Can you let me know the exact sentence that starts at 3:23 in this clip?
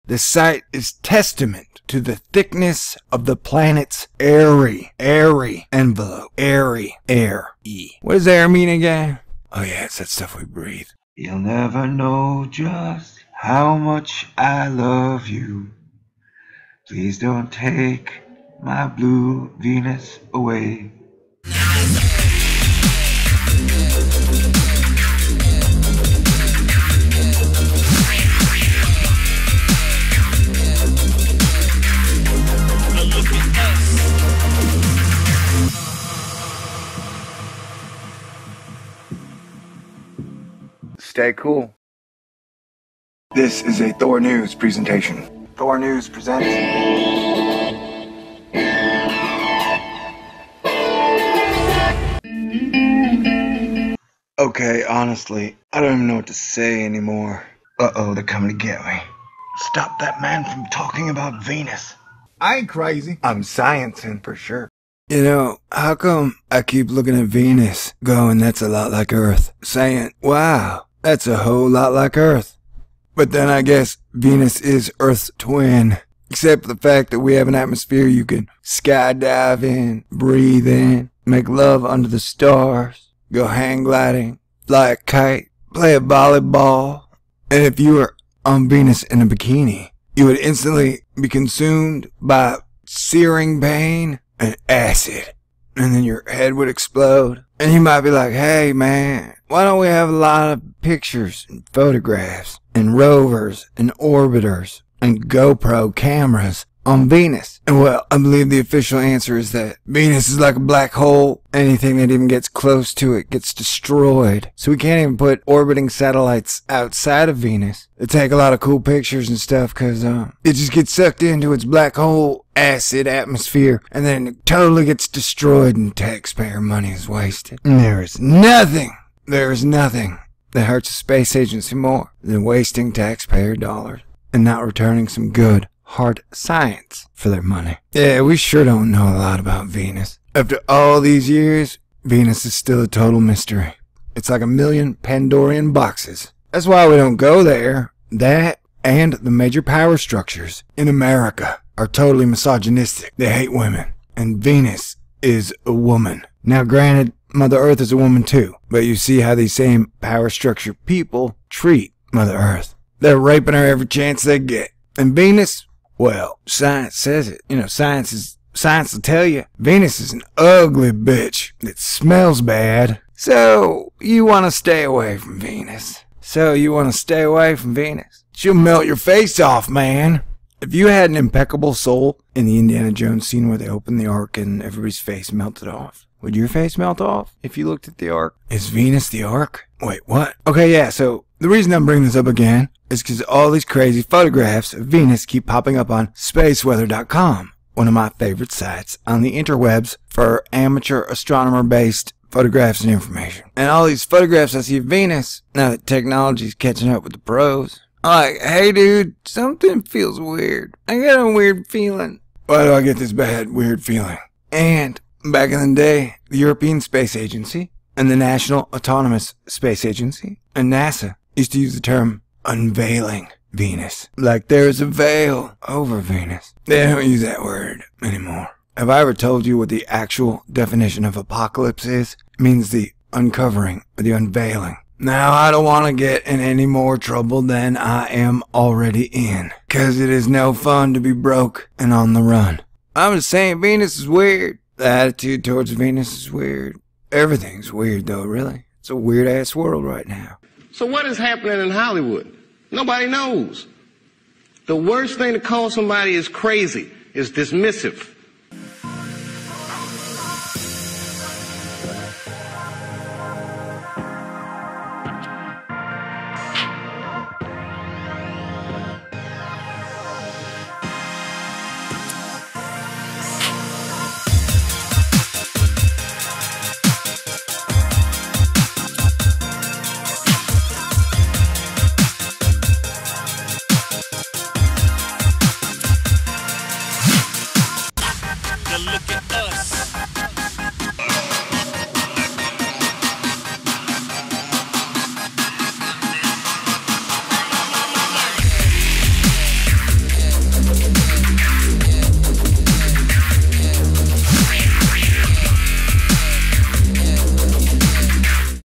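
And all these photographs I see of Venus, now that technology's catching up with the pros, like, hey dude, something feels weird.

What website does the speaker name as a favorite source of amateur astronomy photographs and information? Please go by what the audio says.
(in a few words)
spaceweather.com.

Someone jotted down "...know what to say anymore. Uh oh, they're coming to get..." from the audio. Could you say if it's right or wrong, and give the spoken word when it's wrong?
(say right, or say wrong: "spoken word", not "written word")
right.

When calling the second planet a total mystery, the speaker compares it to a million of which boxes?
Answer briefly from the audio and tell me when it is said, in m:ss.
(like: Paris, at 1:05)
Pandorian boxes, at 2:24.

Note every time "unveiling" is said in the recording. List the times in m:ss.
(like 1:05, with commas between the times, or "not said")
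3:42, 3:54.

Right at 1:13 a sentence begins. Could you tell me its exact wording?
But then I guess Venus is Earth's twin.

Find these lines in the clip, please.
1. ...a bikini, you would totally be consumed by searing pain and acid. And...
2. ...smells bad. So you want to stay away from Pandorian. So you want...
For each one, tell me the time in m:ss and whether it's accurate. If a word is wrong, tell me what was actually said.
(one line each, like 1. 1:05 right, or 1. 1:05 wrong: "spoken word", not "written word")
1. 1:29 wrong: "instantly", not "totally"
2. 2:51 wrong: "Venus", not "Pandorian".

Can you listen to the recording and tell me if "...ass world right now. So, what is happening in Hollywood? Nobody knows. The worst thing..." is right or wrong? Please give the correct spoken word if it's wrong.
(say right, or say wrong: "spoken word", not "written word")
right.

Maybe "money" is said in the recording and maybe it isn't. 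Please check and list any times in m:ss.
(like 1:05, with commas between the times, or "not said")
2:06, 2:17.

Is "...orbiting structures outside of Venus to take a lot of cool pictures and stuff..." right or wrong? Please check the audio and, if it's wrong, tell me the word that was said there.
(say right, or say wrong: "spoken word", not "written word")
wrong: "satellites", not "structures".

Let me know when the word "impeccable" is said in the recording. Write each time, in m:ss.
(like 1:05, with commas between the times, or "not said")
3:01.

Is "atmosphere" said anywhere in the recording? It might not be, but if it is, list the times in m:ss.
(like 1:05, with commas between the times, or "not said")
1:17, 2:03.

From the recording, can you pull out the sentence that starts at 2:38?
But you see how these same power structure people treat Mother Earth.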